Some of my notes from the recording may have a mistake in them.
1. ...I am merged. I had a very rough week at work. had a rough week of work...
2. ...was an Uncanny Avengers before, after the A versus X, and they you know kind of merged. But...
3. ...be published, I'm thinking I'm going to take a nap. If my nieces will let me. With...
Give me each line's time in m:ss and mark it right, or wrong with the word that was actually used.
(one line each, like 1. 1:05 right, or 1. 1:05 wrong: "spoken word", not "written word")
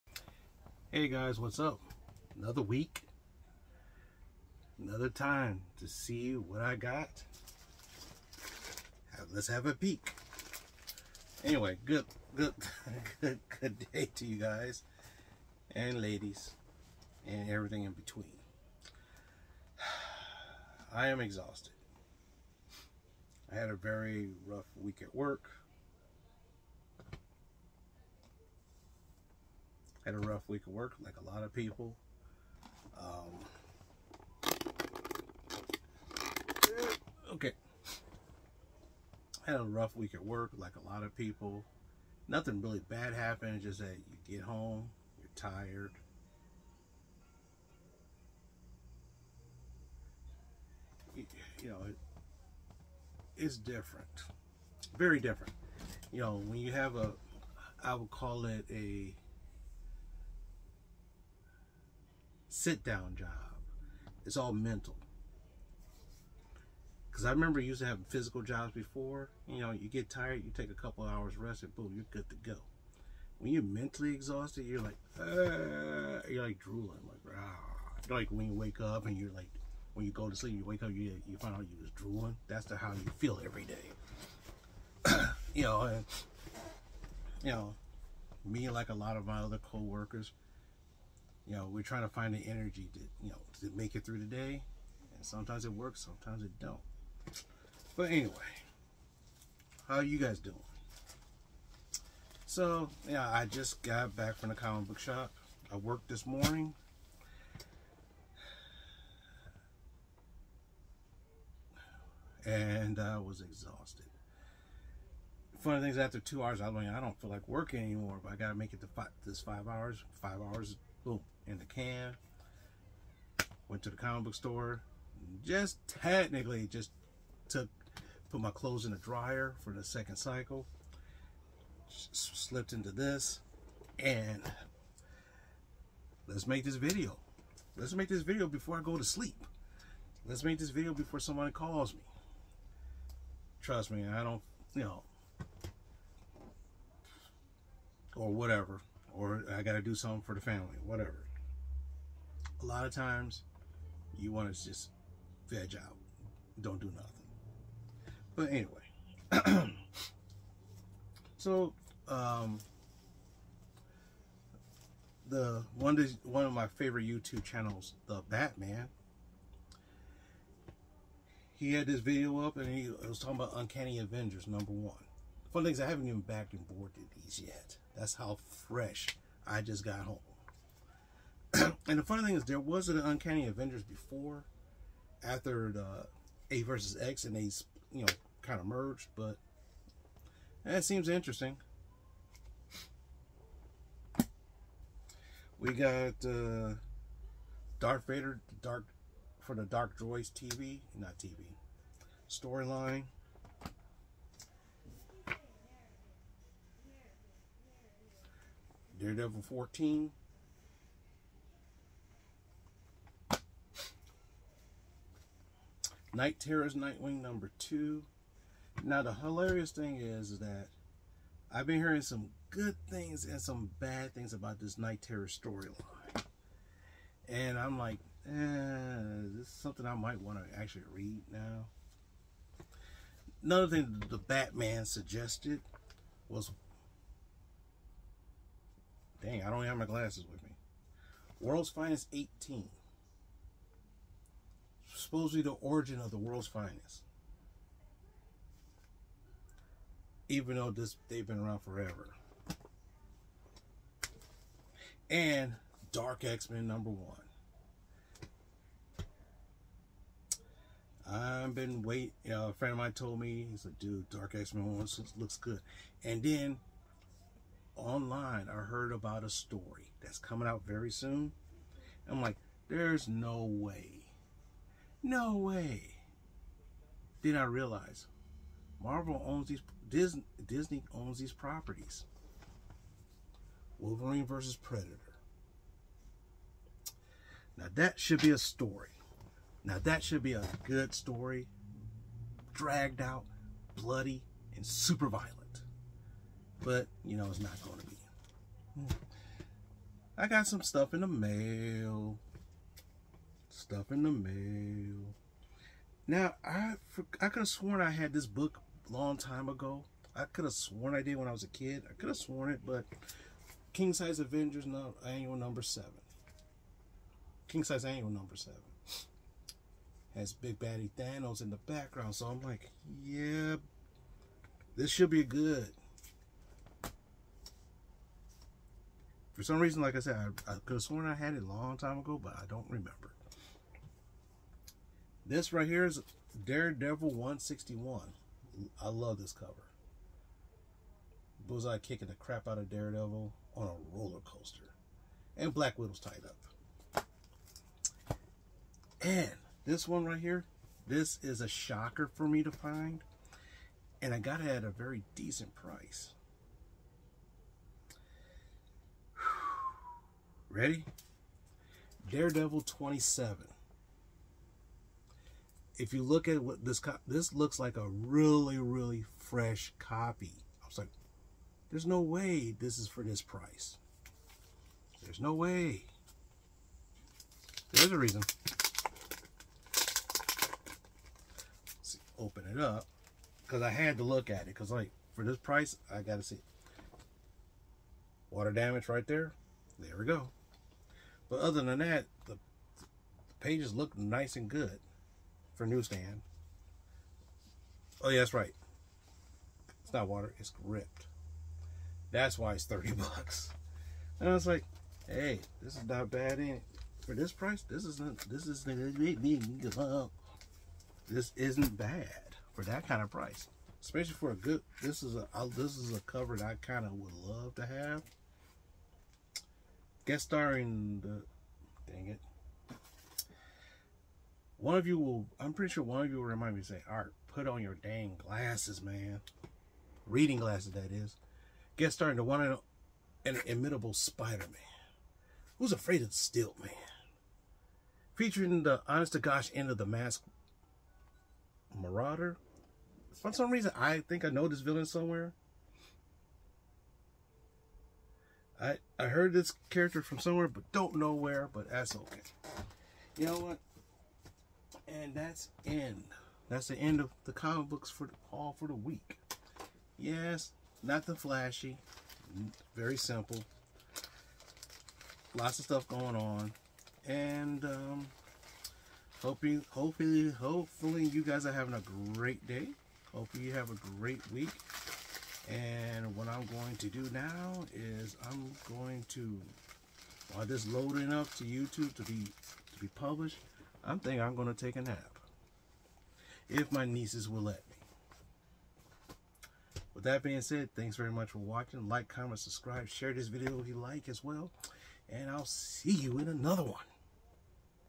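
1. 0:20 wrong: "exhausted", not "merged"
2. 3:02 right
3. 8:02 right.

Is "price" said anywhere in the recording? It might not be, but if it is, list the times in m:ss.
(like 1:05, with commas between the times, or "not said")
5:55, 6:13, 6:25, 6:47, 6:53.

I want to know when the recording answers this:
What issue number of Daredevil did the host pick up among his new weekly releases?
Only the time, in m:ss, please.
3:28.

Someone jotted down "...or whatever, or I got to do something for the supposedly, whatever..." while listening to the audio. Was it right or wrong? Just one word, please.
wrong.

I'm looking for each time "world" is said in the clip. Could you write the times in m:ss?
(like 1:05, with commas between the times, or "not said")
4:01, 4:06.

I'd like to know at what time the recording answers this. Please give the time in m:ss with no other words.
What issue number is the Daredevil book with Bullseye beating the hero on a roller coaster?
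5:36.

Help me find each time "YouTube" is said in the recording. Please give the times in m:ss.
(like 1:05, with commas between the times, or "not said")
2:47, 8:01.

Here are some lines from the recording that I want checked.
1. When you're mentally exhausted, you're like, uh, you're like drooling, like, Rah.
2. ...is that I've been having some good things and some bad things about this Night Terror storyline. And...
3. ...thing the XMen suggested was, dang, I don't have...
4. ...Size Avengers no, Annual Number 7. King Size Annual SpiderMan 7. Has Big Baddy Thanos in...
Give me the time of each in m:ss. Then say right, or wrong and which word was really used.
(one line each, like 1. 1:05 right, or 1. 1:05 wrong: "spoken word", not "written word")
1. 1:13 right
2. 3:40 wrong: "hearing", not "having"
3. 3:53 wrong: "Batman", not "XMen"
4. 5:13 wrong: "Number", not "SpiderMan".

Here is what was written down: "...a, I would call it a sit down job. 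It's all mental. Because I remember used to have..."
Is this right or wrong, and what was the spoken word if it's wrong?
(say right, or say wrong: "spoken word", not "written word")
right.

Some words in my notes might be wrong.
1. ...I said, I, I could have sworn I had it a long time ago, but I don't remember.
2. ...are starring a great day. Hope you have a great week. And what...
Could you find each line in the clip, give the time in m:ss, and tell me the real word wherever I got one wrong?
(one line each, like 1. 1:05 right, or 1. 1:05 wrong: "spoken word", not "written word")
1. 5:29 right
2. 7:51 wrong: "having", not "starring".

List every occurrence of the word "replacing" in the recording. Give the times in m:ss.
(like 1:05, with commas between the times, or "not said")
not said.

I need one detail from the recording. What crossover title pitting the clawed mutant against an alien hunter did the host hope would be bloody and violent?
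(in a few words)
Wolverine versus Predator.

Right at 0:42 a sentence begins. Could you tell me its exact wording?
Nothing really bad happened, just that you get home, you're tired.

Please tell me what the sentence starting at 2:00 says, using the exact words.
Five hours, boom, in the can.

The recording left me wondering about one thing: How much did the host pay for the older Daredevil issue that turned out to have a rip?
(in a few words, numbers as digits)
$30.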